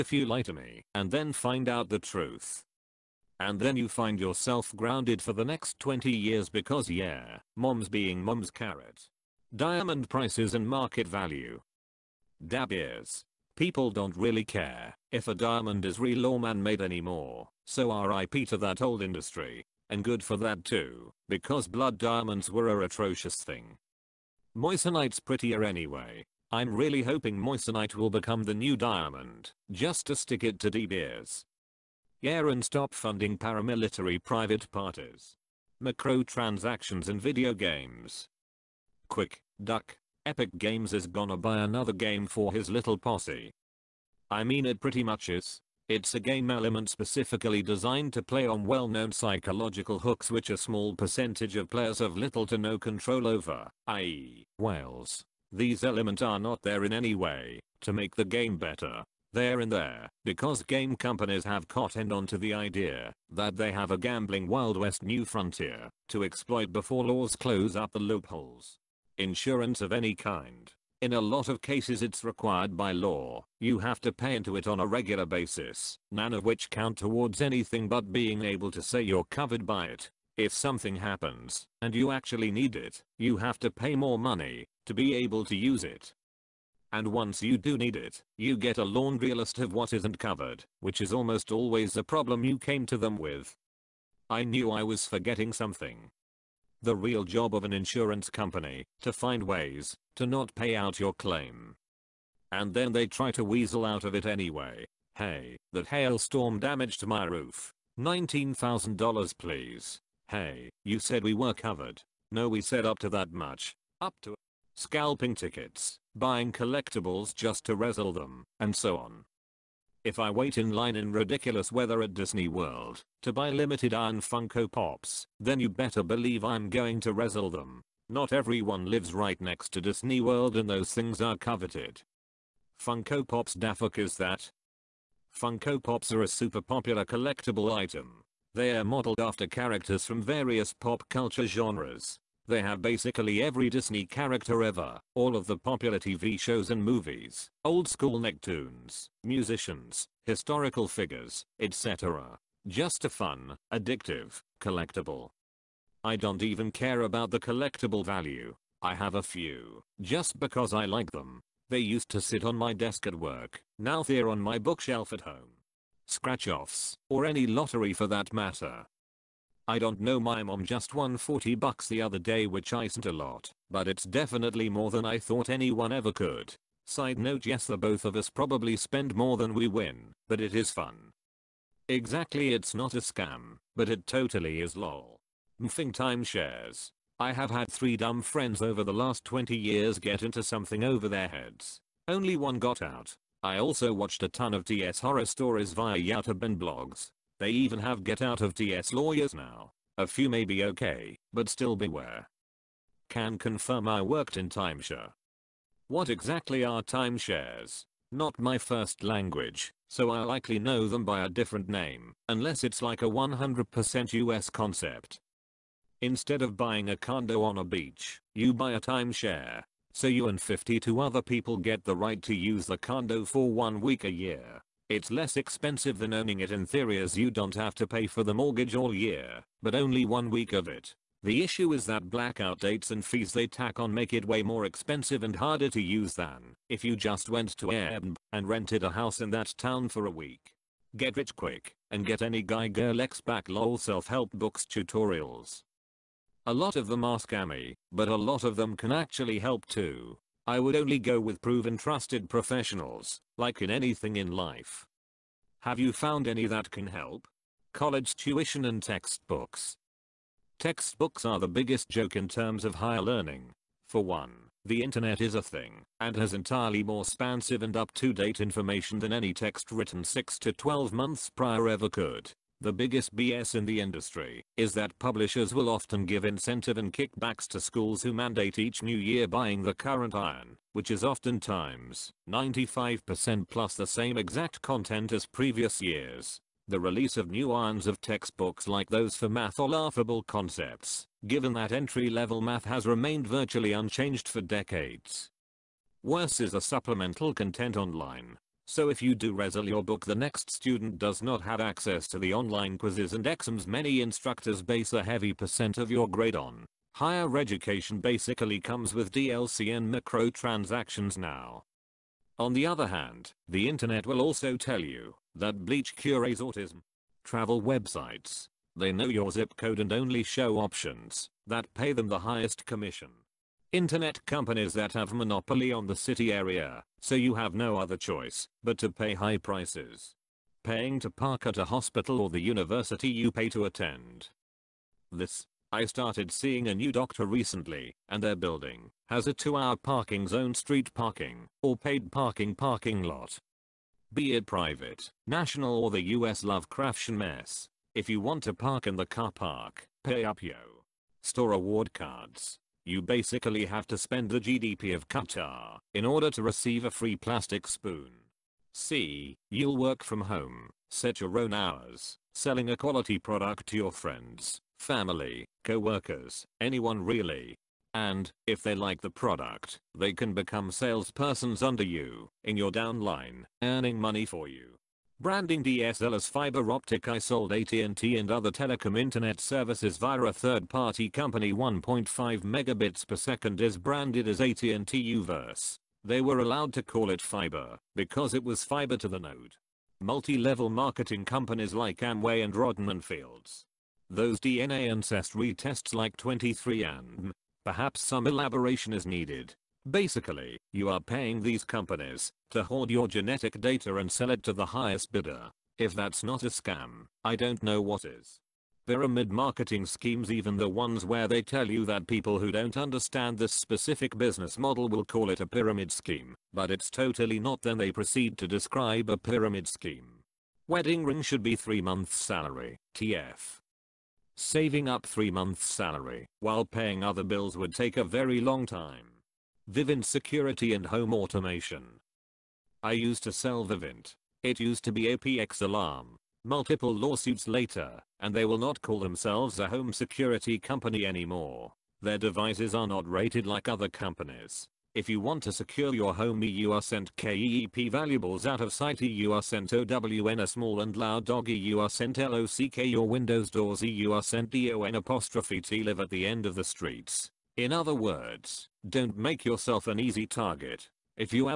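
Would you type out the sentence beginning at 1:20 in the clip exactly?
If something happens, and you actually need it, you have to pay more money, to be able to use it.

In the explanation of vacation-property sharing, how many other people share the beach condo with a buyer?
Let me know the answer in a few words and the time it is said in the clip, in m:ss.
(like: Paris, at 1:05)
52, at 3:40.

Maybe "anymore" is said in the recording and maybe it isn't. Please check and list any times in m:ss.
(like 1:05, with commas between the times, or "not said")
0:16, 7:21.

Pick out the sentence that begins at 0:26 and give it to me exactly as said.
I'm really hoping Moissanite will become the new diamond, just to stick it to De Beers.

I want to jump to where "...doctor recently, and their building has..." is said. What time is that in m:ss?
5:36.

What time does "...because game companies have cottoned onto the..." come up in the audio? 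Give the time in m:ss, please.
1:00.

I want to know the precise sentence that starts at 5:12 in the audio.
On the other hand, the internet will also tell you that Bleach cures autism.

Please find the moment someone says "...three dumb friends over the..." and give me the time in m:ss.
3:07.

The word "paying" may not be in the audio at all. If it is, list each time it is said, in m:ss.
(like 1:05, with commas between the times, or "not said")
5:30, 6:40, 7:06.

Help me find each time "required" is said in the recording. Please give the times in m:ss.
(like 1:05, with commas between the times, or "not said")
1:12.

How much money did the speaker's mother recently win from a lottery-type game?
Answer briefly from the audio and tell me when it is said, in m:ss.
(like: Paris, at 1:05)
40 dollars, at 2:51.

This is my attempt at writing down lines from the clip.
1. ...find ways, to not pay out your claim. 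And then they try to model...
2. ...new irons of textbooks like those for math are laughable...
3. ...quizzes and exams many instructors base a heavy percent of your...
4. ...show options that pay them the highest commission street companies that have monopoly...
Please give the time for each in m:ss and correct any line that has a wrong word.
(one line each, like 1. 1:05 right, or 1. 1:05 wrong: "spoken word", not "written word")
1. 1:39 wrong: "weasel", not "model"
2. 4:47 right
3. 5:02 right
4. 5:20 wrong: "internet", not "street".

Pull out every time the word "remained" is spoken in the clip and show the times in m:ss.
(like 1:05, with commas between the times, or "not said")
4:52.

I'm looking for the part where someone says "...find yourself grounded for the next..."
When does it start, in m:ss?
0:03.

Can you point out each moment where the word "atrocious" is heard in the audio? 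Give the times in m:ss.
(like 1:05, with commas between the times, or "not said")
0:22.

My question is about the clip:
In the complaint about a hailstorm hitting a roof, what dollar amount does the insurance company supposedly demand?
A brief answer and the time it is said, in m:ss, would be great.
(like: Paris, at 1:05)
$19,000, at 1:47.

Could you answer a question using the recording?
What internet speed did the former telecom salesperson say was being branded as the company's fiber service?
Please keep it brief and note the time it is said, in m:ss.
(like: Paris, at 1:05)
1.5 megabits per second, at 6:21.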